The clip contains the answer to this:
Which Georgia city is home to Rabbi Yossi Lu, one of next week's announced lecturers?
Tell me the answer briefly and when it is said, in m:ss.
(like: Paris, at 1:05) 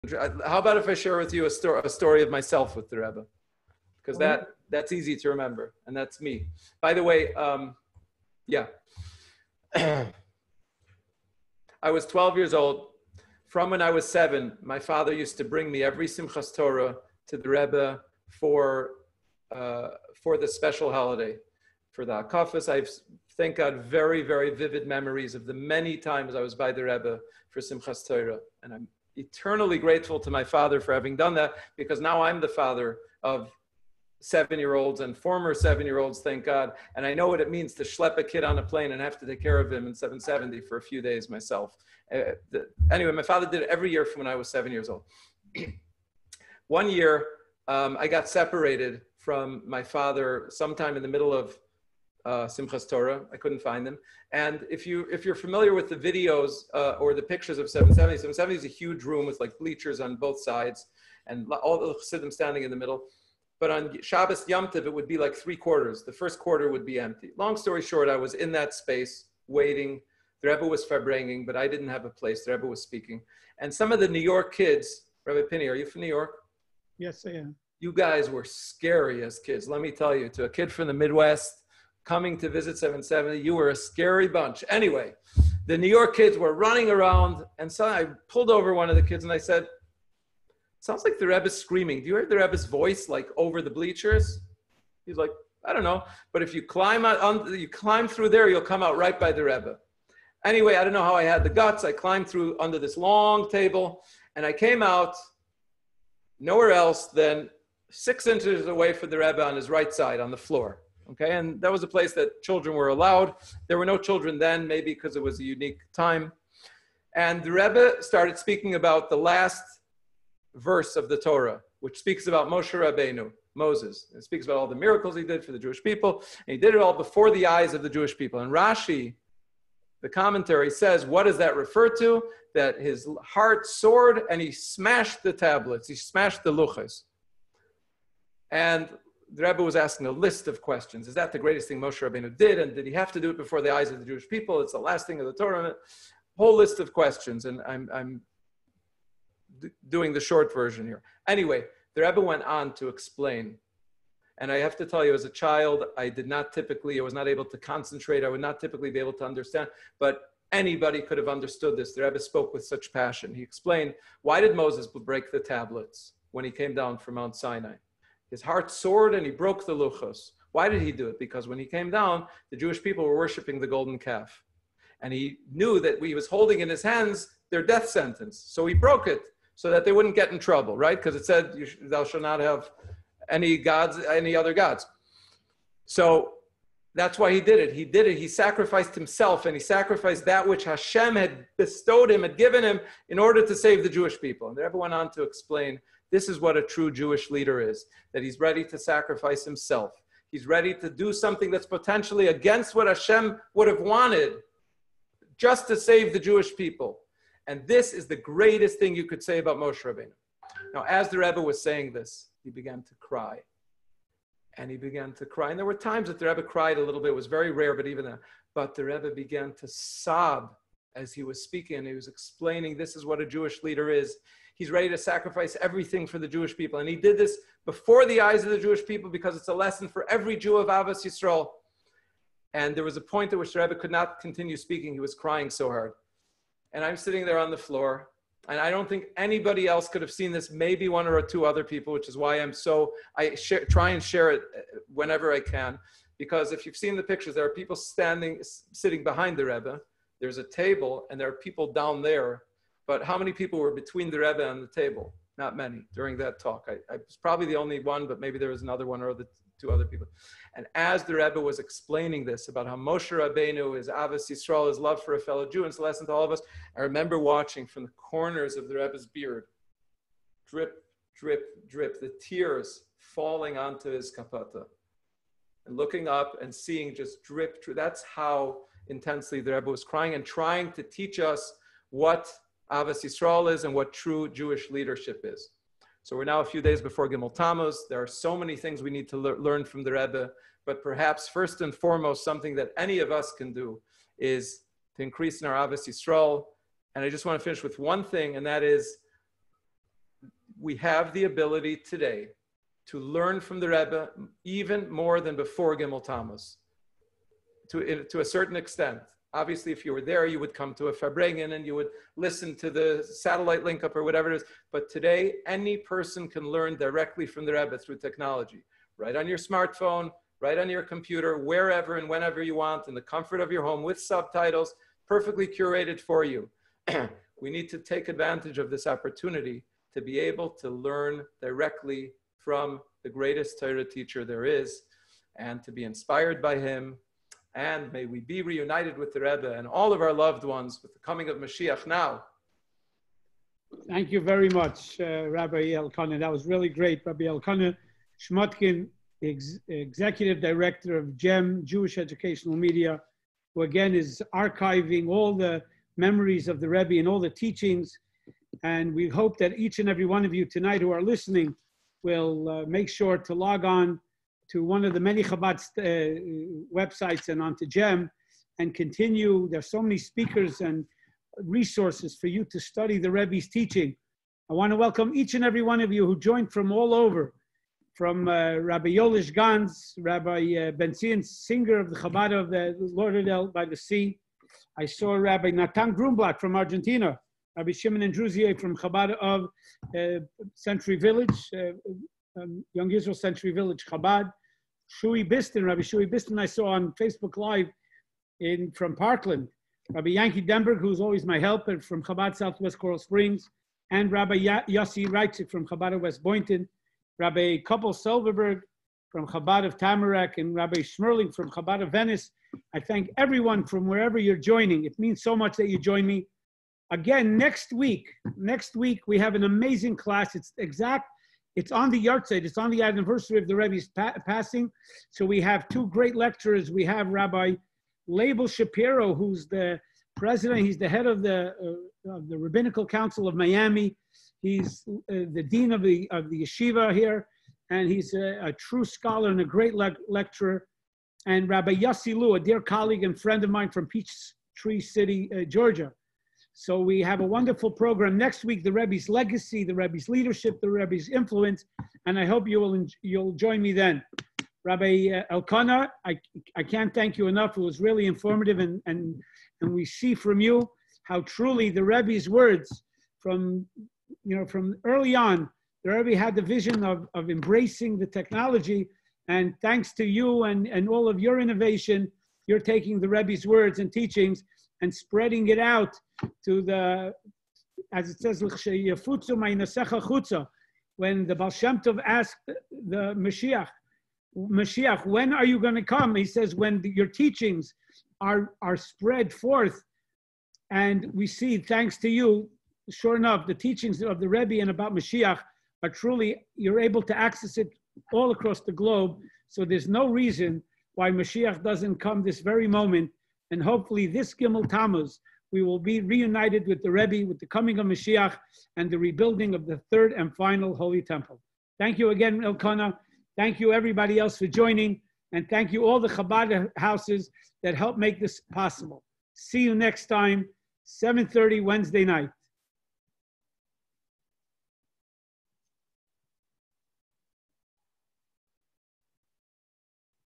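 Peachtree City, at 7:23.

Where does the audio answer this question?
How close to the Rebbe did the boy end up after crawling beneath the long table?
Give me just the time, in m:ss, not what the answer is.
1:47.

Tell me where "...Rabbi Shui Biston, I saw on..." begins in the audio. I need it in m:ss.
6:35.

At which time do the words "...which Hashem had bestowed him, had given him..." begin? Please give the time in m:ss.
3:10.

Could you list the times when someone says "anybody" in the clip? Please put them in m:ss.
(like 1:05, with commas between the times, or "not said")
2:40, 3:59.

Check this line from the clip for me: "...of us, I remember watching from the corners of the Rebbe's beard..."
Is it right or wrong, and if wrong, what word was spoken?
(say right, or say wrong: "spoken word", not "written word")
right.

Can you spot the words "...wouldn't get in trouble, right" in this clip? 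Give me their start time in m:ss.
2:59.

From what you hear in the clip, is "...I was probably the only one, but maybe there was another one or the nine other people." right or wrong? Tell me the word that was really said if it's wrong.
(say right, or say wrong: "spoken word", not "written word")
wrong: "two", not "nine".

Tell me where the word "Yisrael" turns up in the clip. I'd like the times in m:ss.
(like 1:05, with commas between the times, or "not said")
3:51, 4:24, 4:43, 4:55.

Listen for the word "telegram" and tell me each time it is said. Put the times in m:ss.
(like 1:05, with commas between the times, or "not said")
not said.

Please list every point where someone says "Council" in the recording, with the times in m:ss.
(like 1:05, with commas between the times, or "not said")
7:12.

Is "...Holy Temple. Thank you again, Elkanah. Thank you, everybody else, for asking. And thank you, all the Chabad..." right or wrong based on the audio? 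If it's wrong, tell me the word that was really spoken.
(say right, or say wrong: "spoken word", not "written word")
wrong: "joining", not "asking".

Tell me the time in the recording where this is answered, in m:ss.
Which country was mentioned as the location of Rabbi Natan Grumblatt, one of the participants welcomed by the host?
6:26.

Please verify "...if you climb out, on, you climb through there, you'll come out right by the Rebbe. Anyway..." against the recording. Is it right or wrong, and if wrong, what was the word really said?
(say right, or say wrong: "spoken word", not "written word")
right.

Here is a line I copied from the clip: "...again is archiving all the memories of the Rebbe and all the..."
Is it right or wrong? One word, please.
right.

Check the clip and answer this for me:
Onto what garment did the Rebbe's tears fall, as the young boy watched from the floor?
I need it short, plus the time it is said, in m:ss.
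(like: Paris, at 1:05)
kapota, at 4:34.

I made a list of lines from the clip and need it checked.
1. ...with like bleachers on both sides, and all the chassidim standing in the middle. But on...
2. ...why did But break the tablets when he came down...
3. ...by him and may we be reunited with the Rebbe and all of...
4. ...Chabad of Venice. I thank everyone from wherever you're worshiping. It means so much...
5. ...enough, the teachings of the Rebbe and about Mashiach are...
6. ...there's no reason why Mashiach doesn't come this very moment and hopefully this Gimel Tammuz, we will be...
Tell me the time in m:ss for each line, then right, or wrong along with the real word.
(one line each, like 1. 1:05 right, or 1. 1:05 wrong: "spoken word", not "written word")
1. 0:59 right
2. 2:44 wrong: "Moses", not "But"
3. 5:36 right
4. 6:51 wrong: "joining", not "worshiping"
5. 8:13 right
6. 8:19 right.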